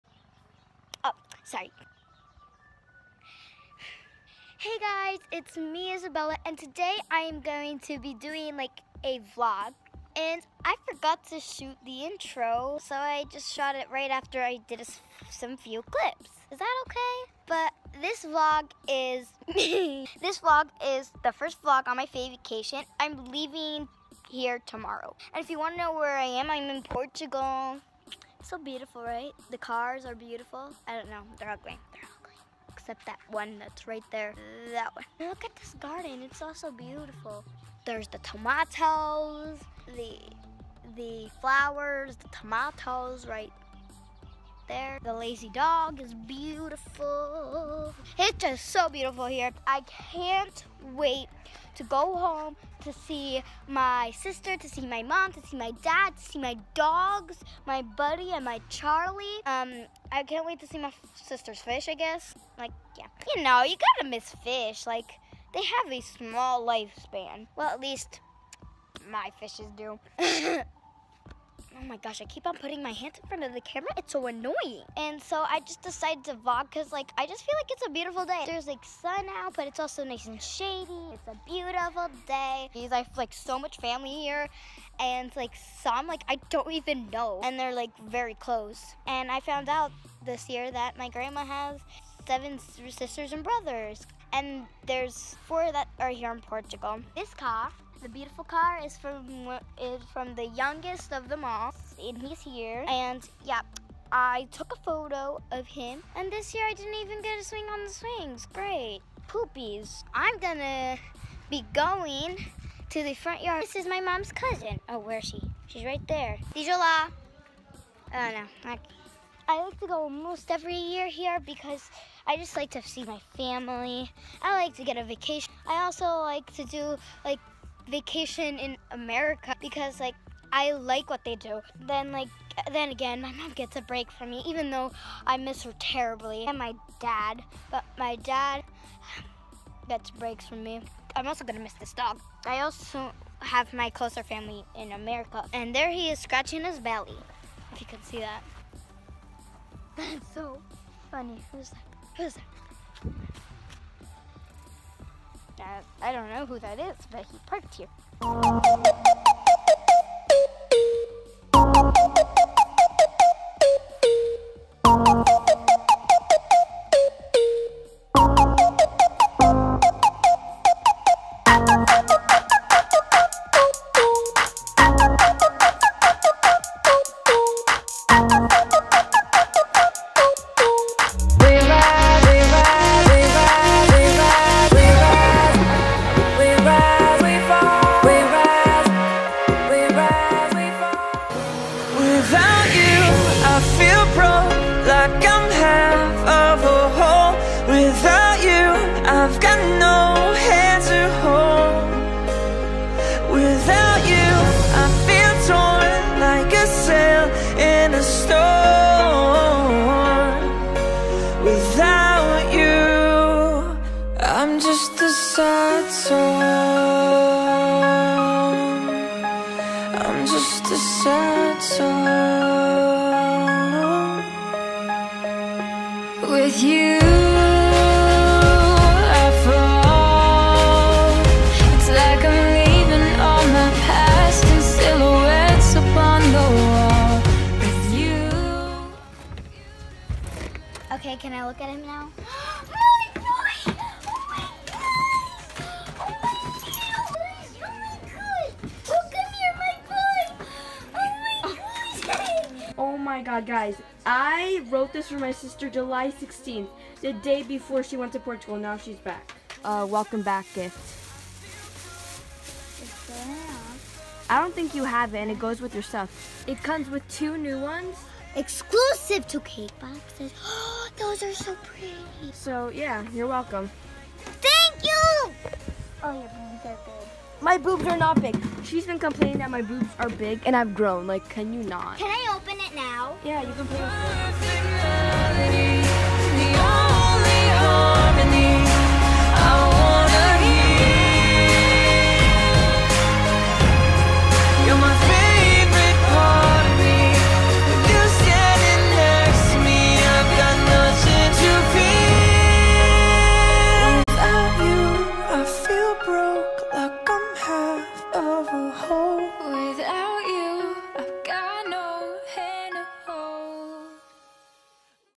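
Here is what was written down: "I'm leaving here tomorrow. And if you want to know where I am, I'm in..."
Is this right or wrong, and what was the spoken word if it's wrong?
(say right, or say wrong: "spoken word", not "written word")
right.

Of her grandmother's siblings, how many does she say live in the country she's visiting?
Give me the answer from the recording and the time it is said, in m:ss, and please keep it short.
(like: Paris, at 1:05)
4, at 1:35.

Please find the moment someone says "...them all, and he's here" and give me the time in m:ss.
1:41.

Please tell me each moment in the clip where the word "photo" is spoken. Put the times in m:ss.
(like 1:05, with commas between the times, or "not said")
1:44.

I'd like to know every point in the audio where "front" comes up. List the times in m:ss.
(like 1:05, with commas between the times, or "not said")
1:13, 1:53.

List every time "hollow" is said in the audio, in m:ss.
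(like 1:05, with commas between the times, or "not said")
not said.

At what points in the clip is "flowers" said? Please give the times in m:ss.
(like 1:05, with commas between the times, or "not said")
0:41.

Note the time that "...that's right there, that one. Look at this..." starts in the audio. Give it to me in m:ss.
0:33.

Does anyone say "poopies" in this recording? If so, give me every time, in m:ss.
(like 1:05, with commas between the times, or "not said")
1:49.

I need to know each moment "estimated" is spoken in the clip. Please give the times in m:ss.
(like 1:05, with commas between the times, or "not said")
not said.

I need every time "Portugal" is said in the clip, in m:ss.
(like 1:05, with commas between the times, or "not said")
0:26, 1:36, 4:18.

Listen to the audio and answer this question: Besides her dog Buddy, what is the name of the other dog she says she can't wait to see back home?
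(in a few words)
Charlie.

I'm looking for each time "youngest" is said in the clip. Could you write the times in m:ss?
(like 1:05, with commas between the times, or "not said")
1:40.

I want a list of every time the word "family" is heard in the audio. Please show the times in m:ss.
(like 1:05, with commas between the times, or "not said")
1:23, 2:03, 2:24.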